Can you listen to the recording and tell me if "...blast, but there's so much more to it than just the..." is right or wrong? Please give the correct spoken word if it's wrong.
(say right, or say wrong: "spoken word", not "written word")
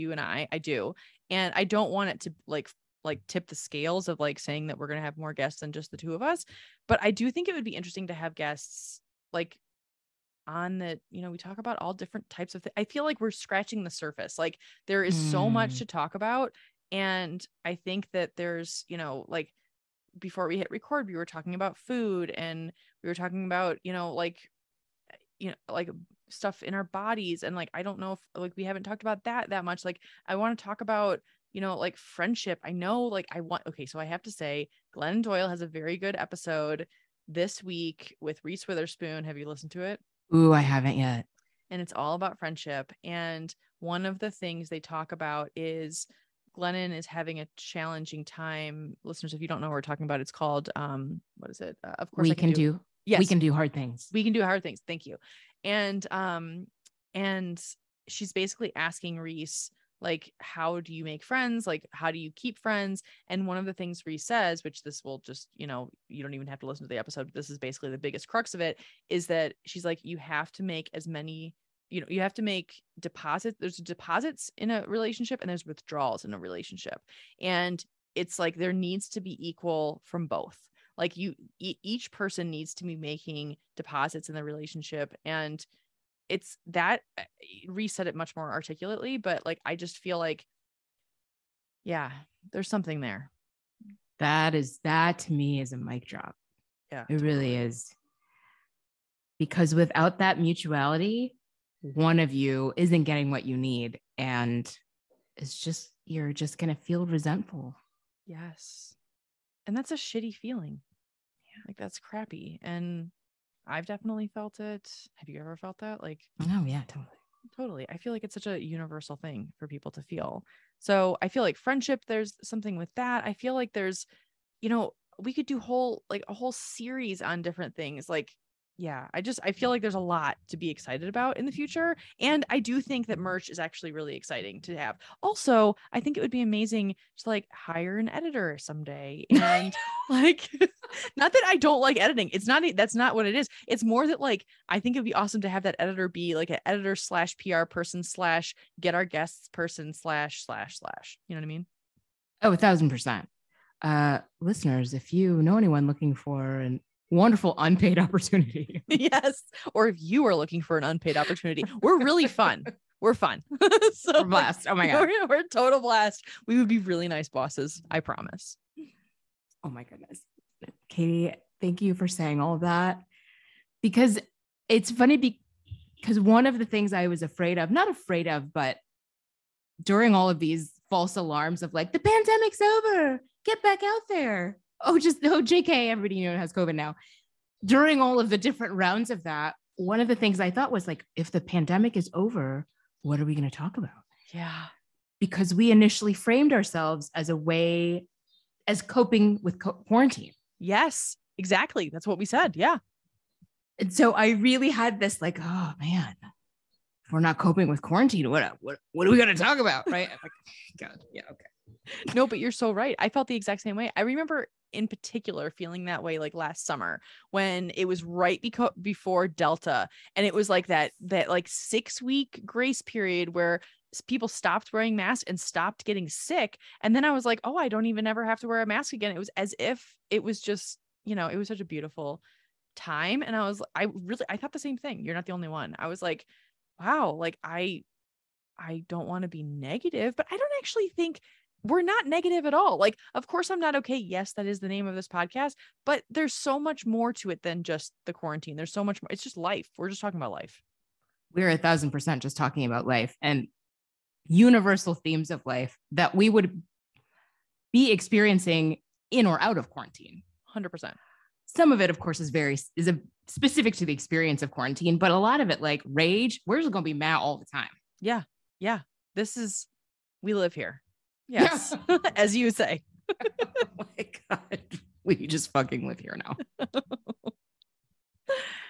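wrong: "podcast", not "blast".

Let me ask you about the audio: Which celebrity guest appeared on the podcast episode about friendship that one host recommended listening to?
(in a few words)
Reese Witherspoon.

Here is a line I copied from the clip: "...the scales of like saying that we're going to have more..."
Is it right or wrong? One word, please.
right.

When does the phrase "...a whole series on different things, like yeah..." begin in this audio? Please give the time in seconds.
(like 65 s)
126 s.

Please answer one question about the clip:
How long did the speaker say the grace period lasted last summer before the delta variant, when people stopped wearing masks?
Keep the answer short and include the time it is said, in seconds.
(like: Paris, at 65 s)
6 weeks, at 221 s.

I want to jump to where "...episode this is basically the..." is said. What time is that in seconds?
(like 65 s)
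66 s.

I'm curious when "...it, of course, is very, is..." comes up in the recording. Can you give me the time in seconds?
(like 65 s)
261 s.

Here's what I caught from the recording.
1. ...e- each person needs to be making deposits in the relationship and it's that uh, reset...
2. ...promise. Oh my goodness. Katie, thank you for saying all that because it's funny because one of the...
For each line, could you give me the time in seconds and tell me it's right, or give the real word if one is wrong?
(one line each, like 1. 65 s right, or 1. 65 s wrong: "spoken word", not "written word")
1. 81 s right
2. 167 s right.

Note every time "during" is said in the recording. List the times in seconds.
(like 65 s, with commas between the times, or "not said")
179 s, 187 s.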